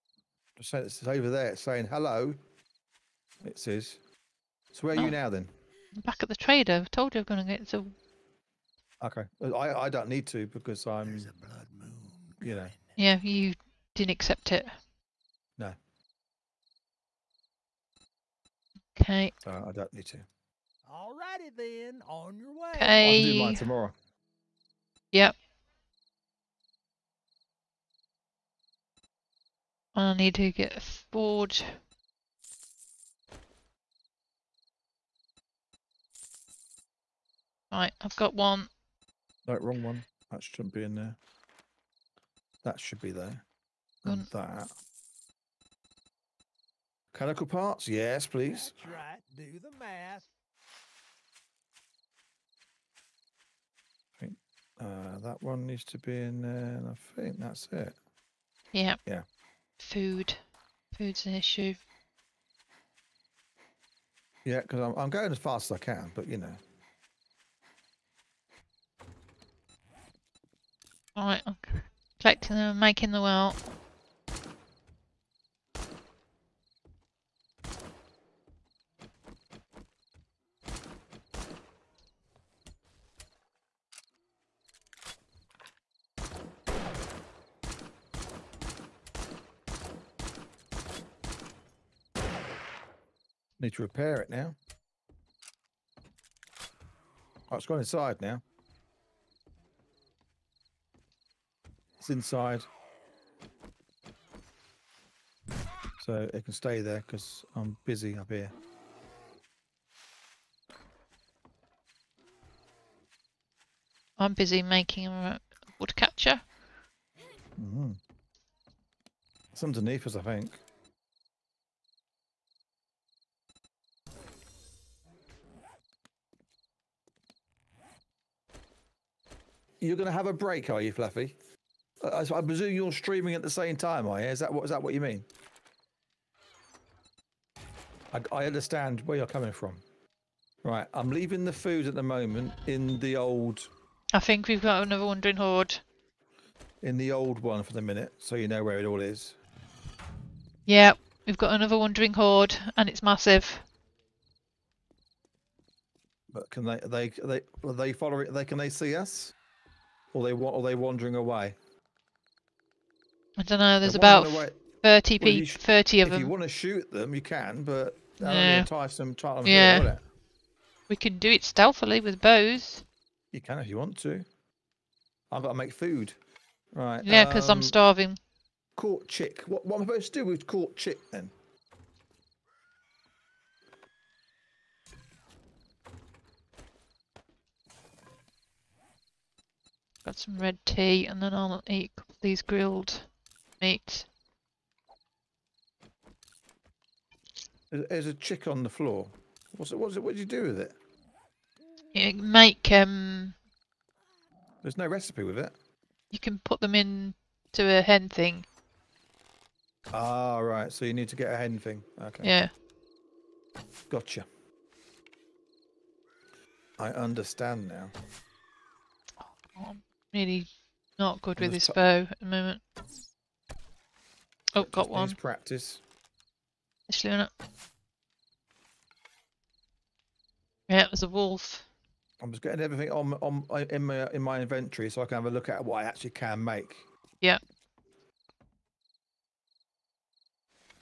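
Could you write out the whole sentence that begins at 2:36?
But can they, they, they, are they following, they, can they see us?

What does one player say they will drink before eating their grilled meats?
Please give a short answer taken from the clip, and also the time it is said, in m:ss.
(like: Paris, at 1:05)
Red tea, at 3:10.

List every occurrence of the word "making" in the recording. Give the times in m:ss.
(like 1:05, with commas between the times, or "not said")
1:12, 1:54.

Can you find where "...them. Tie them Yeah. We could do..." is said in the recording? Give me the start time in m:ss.
2:48.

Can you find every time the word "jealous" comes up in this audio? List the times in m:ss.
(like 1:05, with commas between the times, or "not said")
not said.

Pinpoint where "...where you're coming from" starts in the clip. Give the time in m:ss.
2:19.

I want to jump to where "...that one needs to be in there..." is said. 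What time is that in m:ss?
0:55.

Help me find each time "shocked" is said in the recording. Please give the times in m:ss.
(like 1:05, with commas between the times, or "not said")
not said.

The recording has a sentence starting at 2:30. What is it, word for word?
Yeah, we've got another Wandering Horde, and it's massive.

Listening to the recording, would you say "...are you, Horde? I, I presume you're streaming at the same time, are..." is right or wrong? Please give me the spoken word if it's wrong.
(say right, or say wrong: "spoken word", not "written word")
wrong: "Fluffy", not "Horde".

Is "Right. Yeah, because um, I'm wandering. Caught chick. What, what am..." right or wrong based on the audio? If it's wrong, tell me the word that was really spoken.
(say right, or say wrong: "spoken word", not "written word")
wrong: "starving", not "wandering".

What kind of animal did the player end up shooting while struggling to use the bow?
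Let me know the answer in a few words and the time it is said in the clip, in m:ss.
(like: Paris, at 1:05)
A wolf, at 3:51.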